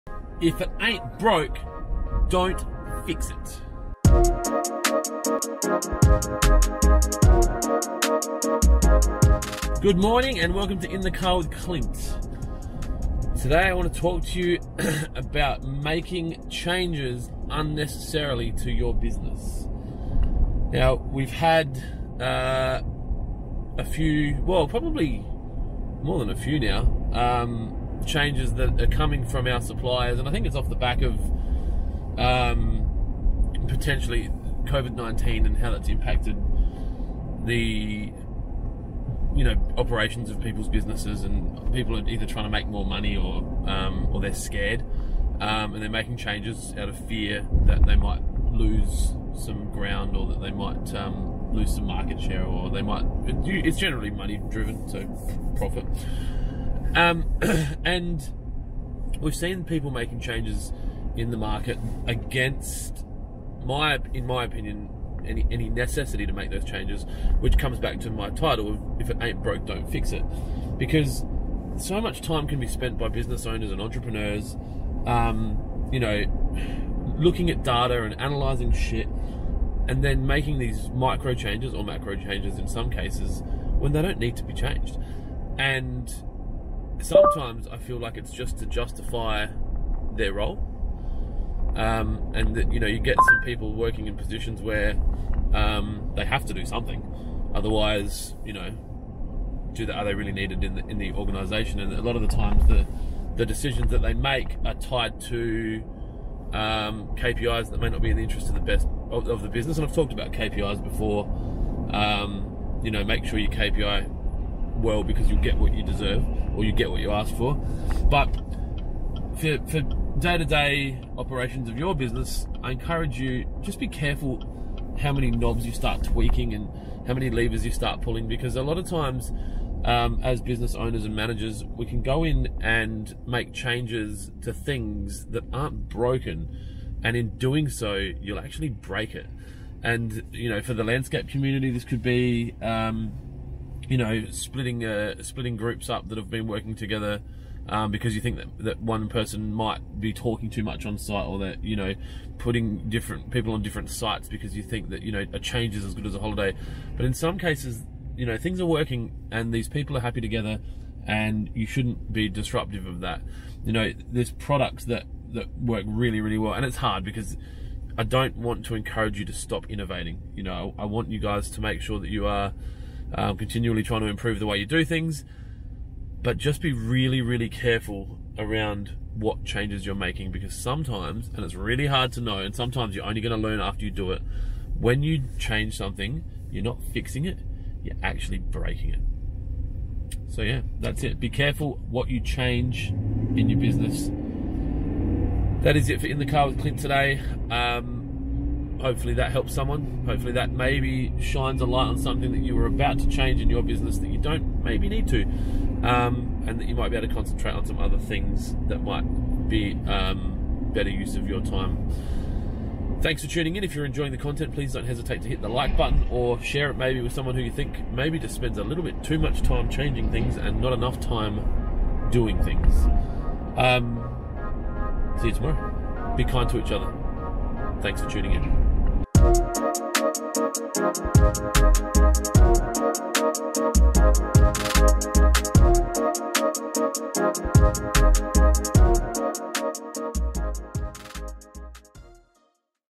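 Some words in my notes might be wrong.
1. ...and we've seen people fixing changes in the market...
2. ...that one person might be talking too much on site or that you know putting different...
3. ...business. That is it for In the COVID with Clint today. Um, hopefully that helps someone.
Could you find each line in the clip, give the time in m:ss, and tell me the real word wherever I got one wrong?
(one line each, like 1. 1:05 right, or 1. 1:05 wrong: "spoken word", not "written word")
1. 0:57 wrong: "making", not "fixing"
2. 2:28 right
3. 3:13 wrong: "Car", not "COVID".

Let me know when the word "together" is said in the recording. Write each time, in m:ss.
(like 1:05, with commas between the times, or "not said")
2:26, 2:40.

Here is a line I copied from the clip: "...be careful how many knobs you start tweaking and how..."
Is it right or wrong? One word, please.
right.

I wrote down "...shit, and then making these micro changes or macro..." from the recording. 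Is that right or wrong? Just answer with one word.
right.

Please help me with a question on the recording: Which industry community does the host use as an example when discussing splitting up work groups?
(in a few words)
Landscape.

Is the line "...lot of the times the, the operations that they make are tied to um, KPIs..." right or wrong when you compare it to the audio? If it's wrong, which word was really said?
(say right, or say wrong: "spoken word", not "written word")
wrong: "decisions", not "operations".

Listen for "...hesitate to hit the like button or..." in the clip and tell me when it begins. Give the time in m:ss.
3:34.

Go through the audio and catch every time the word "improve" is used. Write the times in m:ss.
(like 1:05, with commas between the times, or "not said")
2:54.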